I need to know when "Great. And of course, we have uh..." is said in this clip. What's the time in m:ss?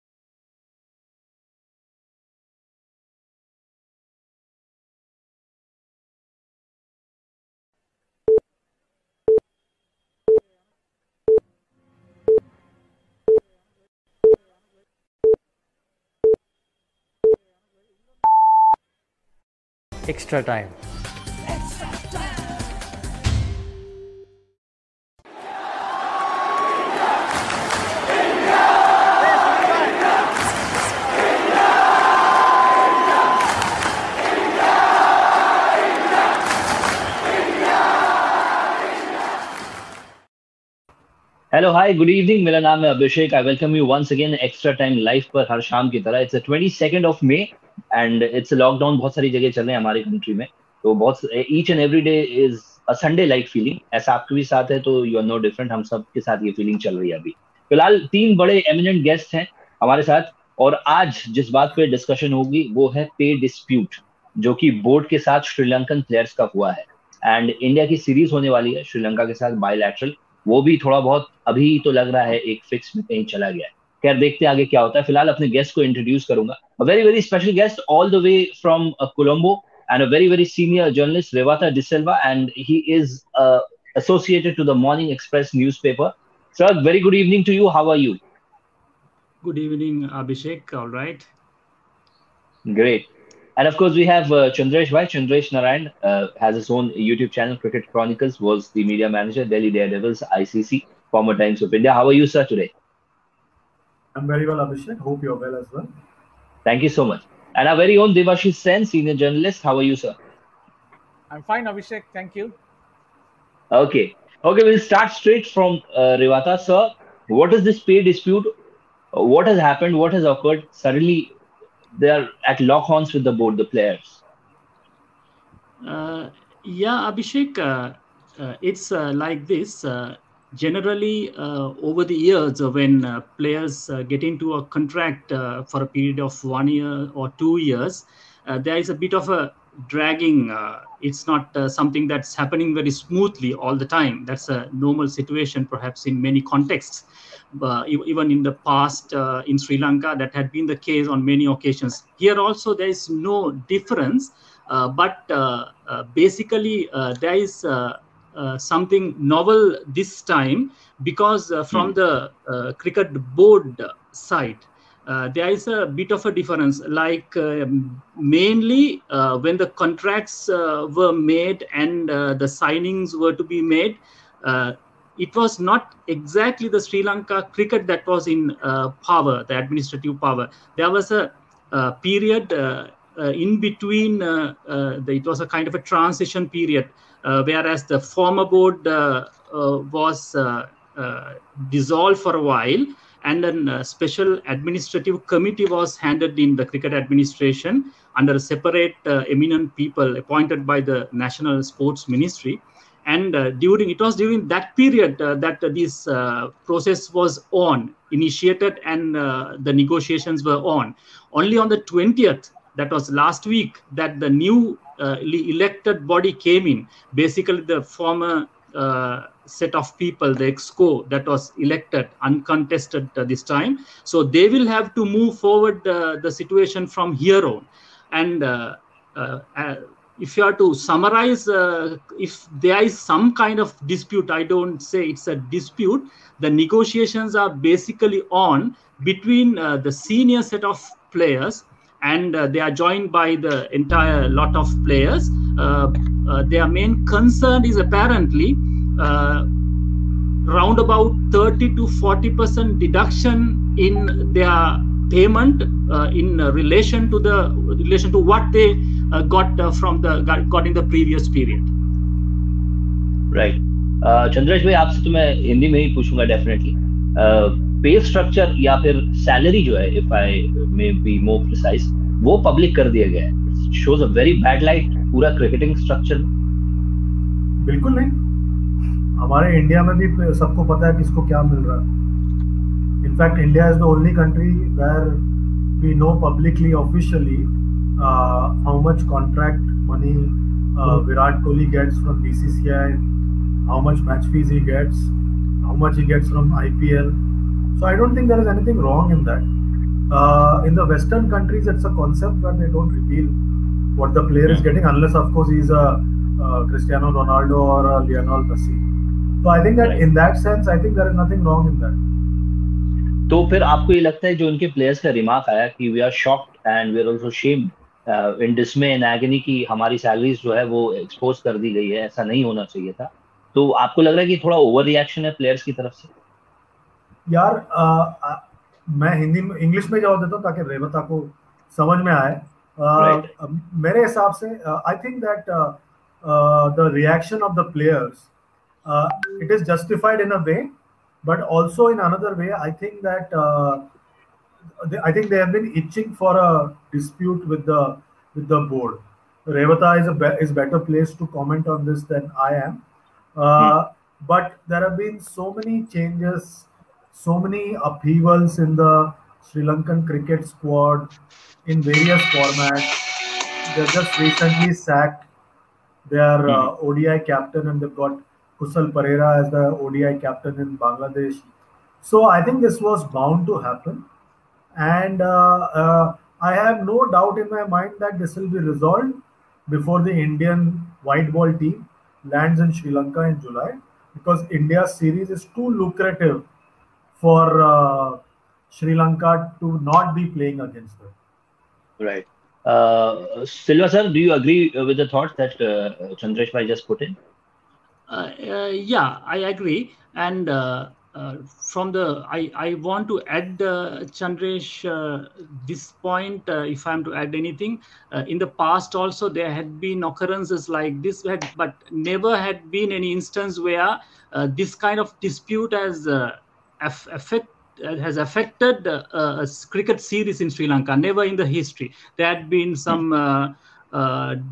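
1:32.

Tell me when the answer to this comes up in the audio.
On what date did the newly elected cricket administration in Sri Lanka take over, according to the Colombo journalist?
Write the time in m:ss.
3:31.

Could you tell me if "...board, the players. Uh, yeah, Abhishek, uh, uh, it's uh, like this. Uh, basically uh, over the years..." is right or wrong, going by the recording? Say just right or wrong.
wrong.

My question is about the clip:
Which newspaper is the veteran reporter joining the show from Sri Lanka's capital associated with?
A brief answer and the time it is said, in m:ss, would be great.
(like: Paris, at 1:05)
Morning Express, at 1:24.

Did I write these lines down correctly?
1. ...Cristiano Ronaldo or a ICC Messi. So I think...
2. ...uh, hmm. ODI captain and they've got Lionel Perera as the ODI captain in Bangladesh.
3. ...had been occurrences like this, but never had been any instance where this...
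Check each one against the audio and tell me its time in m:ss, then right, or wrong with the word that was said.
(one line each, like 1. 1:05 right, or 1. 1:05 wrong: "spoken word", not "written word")
1. 5:06 wrong: "Lionel", not "ICC"
2. 6:06 wrong: "Kusal", not "Lionel"
3. 6:49 right.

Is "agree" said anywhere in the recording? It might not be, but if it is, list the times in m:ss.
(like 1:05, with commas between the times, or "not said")
6:34, 6:39.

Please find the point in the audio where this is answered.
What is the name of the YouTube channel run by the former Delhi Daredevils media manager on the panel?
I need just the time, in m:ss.
1:37.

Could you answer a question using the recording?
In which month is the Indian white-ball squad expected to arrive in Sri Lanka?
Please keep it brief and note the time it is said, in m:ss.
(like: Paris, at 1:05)
July, at 6:23.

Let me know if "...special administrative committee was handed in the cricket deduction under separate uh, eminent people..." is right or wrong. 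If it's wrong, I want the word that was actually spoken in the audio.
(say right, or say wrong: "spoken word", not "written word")
wrong: "administration", not "deduction".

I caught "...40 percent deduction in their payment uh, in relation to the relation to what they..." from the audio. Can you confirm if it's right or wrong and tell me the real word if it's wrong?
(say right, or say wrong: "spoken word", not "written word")
right.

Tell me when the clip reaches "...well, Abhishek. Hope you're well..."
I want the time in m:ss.
1:44.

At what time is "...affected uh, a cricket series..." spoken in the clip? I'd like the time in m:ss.
6:58.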